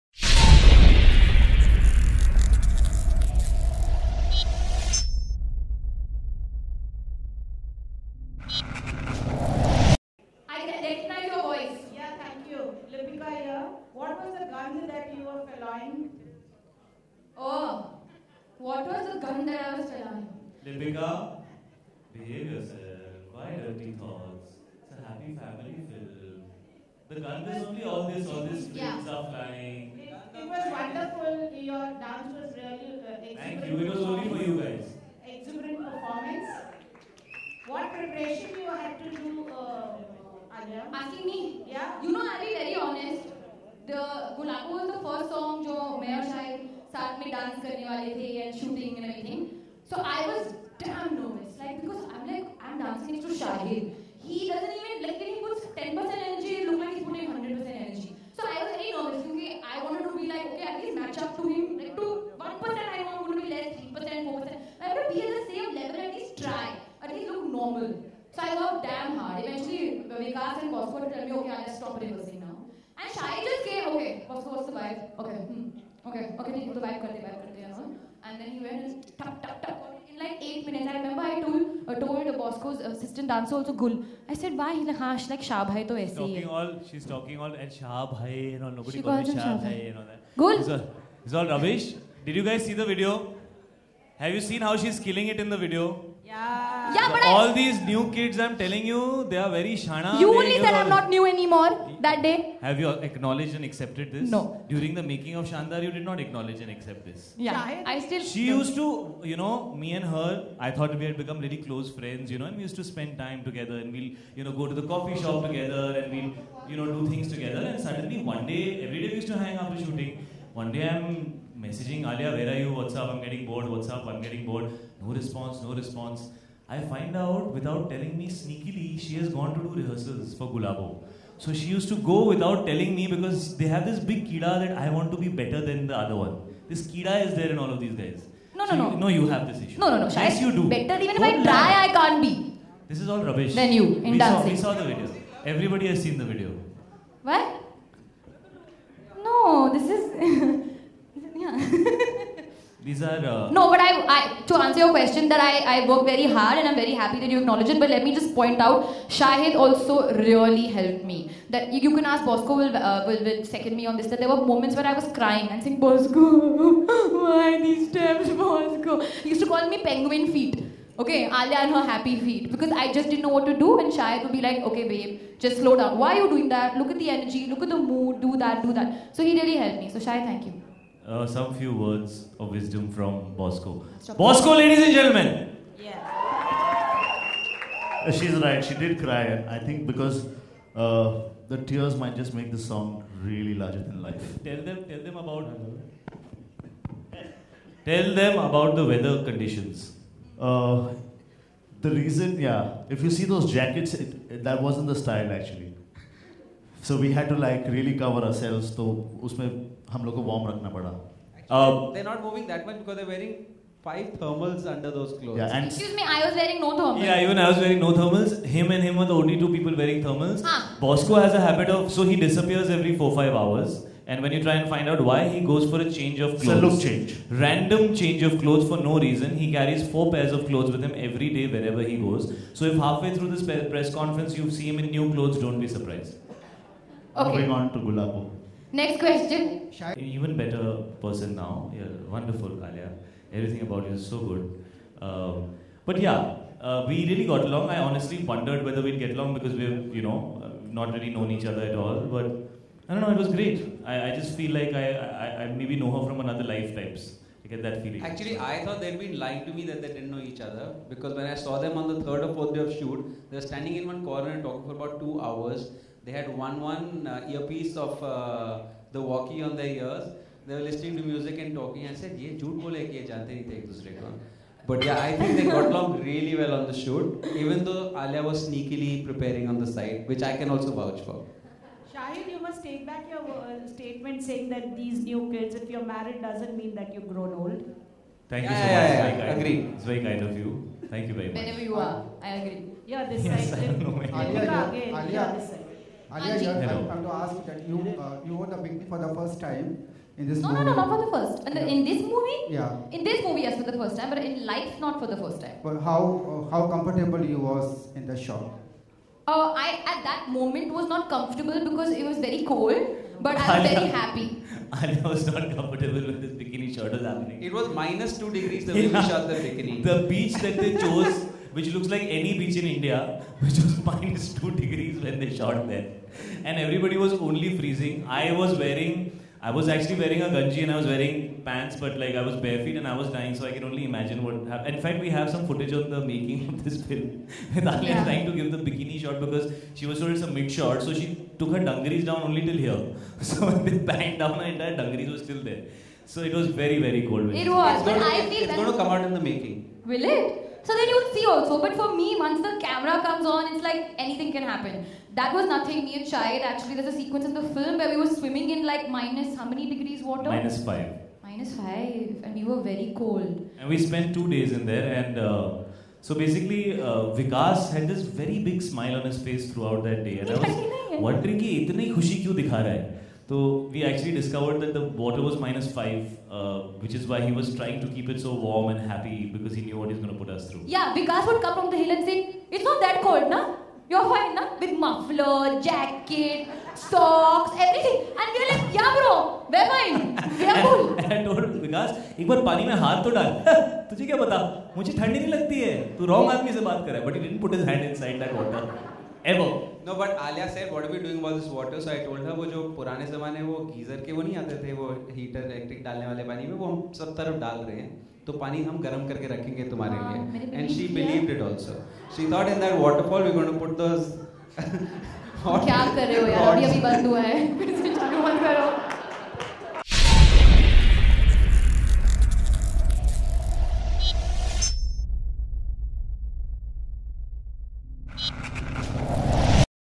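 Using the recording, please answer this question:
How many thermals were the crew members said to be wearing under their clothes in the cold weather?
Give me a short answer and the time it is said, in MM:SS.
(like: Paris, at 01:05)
5, at 03:33.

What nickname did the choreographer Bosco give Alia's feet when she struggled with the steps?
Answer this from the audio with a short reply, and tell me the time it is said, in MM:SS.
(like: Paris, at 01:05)
penguin feet, at 02:49.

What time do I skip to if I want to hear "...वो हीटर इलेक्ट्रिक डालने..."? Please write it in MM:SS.
06:44.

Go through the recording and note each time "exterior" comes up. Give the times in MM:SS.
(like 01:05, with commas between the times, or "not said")
not said.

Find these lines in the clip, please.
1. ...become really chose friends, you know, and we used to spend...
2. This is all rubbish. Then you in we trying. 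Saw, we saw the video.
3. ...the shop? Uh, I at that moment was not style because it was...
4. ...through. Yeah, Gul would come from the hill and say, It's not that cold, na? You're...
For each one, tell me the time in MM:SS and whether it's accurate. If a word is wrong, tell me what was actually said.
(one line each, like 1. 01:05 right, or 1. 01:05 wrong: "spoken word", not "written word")
1. 01:51 wrong: "close", not "chose"
2. 02:22 wrong: "dancing", not "trying"
3. 05:08 wrong: "comfortable", not "style"
4. 06:20 wrong: "Vikas", not "Gul".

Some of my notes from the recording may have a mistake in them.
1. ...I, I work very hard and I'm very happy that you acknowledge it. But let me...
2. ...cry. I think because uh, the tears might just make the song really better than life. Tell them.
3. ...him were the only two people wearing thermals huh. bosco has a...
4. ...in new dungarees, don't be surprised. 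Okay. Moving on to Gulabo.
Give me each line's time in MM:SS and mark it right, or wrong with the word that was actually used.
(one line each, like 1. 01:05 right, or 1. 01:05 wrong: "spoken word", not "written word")
1. 02:35 right
2. 03:09 wrong: "larger", not "better"
3. 03:38 right
4. 03:54 wrong: "clothes", not "dungarees".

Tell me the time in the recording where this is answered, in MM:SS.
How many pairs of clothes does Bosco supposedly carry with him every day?
03:49.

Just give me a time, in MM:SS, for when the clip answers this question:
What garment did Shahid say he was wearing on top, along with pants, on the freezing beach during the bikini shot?
05:30.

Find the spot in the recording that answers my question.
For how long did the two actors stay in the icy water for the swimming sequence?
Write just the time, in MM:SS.
06:04.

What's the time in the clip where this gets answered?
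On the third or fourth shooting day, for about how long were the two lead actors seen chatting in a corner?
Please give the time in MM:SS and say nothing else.
04:24.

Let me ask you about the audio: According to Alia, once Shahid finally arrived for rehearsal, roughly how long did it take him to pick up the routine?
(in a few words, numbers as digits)
8 minutes.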